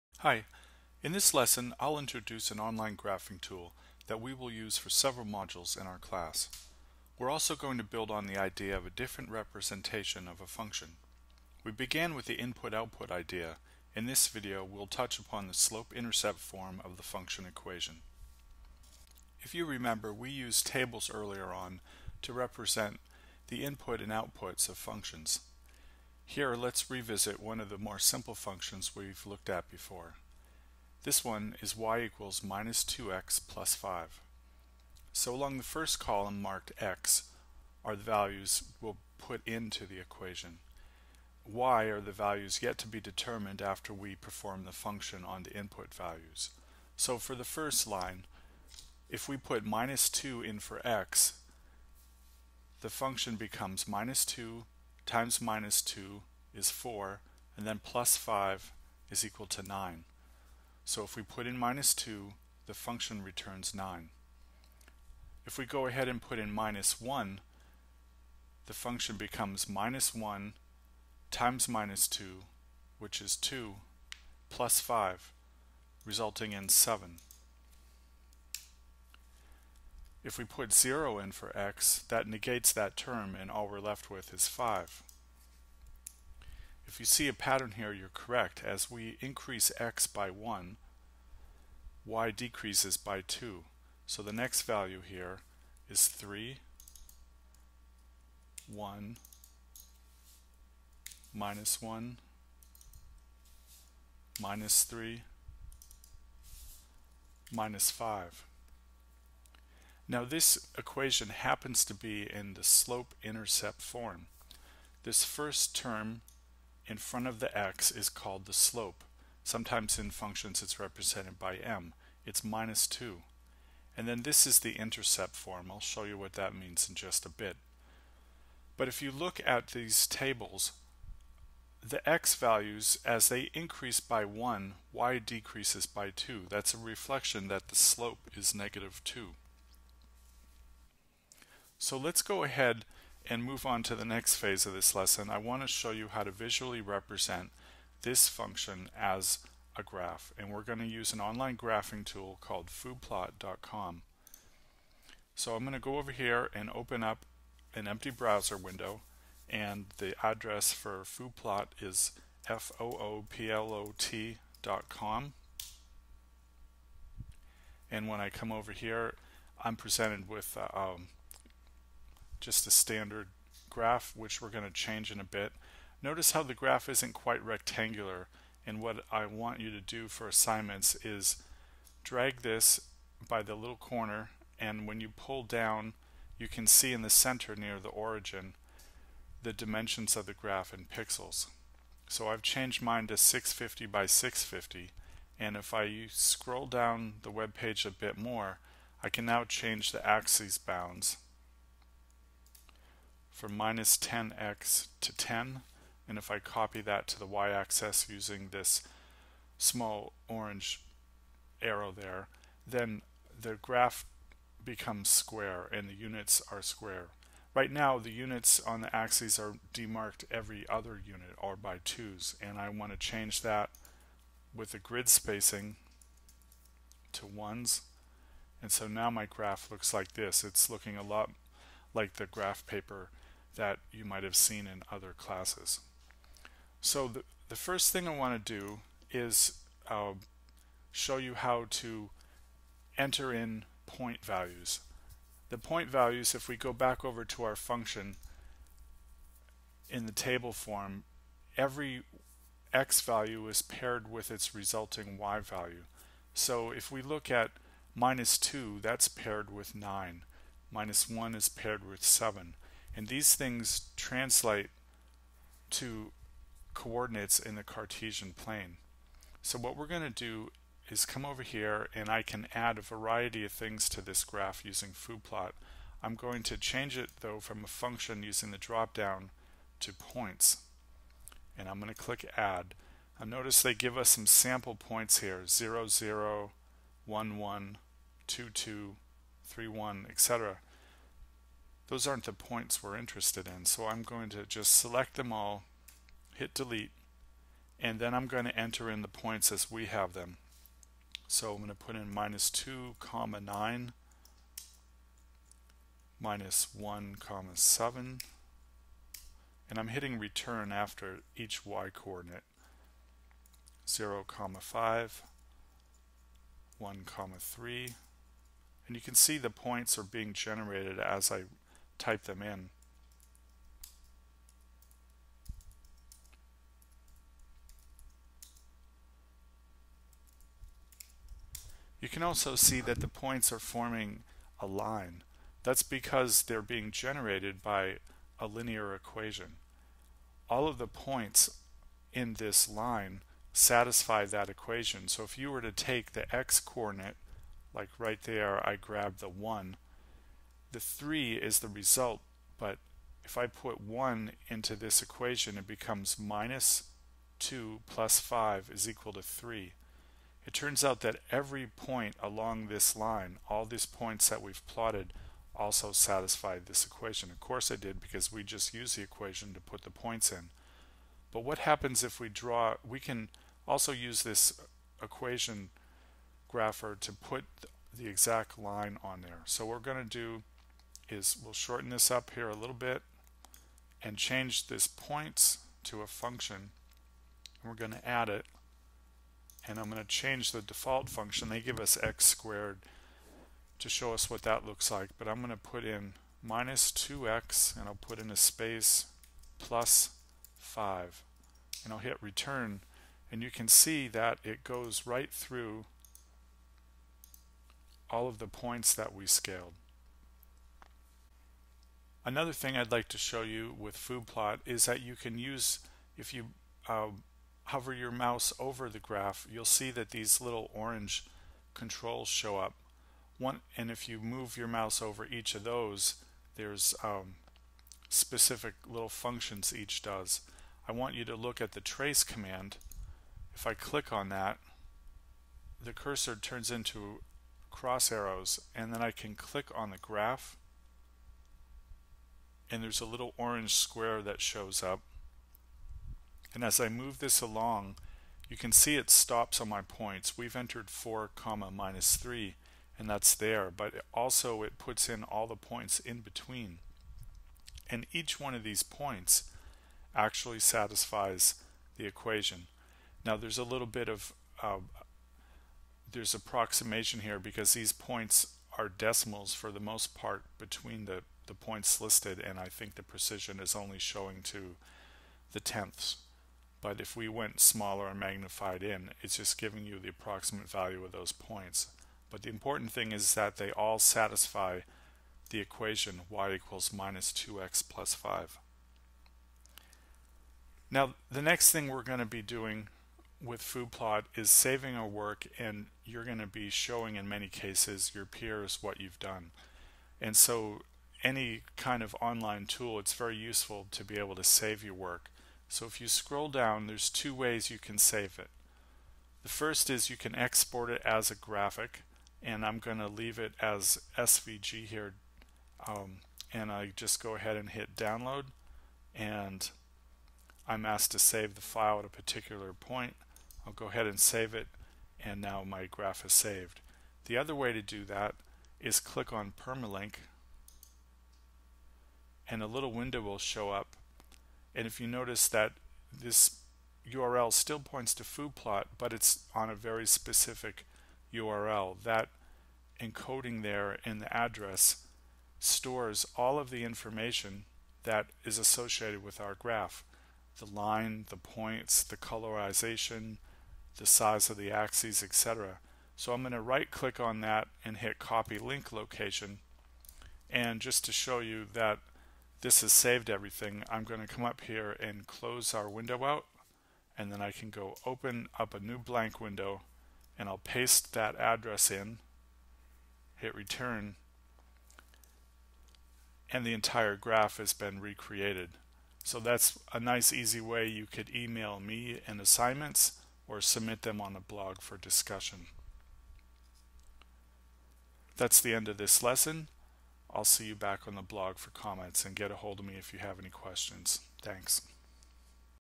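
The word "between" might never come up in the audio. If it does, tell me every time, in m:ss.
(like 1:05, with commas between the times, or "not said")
7:36, 7:50.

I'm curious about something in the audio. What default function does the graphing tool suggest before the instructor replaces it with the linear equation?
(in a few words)
x squared.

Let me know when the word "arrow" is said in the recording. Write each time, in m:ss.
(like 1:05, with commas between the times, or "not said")
3:31, 7:18.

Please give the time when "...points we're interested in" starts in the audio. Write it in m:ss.
4:52.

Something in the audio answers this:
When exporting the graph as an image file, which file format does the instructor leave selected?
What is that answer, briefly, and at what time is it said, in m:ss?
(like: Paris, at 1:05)
SVG, at 8:34.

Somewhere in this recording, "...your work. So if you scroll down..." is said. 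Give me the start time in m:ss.
8:24.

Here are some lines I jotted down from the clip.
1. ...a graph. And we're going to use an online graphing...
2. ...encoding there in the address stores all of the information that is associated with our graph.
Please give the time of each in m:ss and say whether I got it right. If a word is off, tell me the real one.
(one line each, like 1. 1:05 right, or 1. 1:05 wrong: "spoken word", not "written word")
1. 2:29 right
2. 9:03 right.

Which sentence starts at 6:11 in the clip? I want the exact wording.
But what happens if we draw, we can also use this equation grapher to put the exact line on there.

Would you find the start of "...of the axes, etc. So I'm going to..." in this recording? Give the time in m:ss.
9:14.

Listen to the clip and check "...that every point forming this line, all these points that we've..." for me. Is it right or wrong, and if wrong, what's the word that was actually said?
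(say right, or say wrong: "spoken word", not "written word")
wrong: "along", not "forming".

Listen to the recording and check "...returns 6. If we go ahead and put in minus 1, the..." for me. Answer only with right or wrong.
wrong.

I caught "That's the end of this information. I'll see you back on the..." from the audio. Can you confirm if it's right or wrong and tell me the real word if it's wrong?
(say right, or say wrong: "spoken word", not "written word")
wrong: "lesson", not "information".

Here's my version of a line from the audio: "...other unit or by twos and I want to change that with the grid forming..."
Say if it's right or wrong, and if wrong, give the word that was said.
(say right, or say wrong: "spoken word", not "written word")
wrong: "spacing", not "forming".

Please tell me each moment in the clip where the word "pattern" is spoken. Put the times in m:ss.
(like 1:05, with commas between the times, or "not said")
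1:27.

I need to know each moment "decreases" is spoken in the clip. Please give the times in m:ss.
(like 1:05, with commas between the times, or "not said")
1:32, 2:15.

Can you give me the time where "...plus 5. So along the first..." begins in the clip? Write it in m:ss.
0:33.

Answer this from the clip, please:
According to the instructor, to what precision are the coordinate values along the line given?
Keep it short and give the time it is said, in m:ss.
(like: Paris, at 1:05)
tenths, at 7:55.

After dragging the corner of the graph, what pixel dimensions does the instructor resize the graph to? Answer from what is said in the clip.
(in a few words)
650 by 650.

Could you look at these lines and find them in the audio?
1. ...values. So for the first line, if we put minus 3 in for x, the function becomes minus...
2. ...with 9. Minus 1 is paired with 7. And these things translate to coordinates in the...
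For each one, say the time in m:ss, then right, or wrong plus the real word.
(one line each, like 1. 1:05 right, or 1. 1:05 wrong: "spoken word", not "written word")
1. 0:45 wrong: "2", not "3"
2. 4:19 right.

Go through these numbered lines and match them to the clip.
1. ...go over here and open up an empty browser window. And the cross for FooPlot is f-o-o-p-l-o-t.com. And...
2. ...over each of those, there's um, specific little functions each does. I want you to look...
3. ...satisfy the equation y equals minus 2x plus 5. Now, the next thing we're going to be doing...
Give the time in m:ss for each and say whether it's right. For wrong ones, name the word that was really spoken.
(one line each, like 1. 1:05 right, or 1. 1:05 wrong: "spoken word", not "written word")
1. 2:35 wrong: "address", not "cross"
2. 7:05 right
3. 8:03 right.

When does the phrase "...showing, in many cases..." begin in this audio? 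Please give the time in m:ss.
8:16.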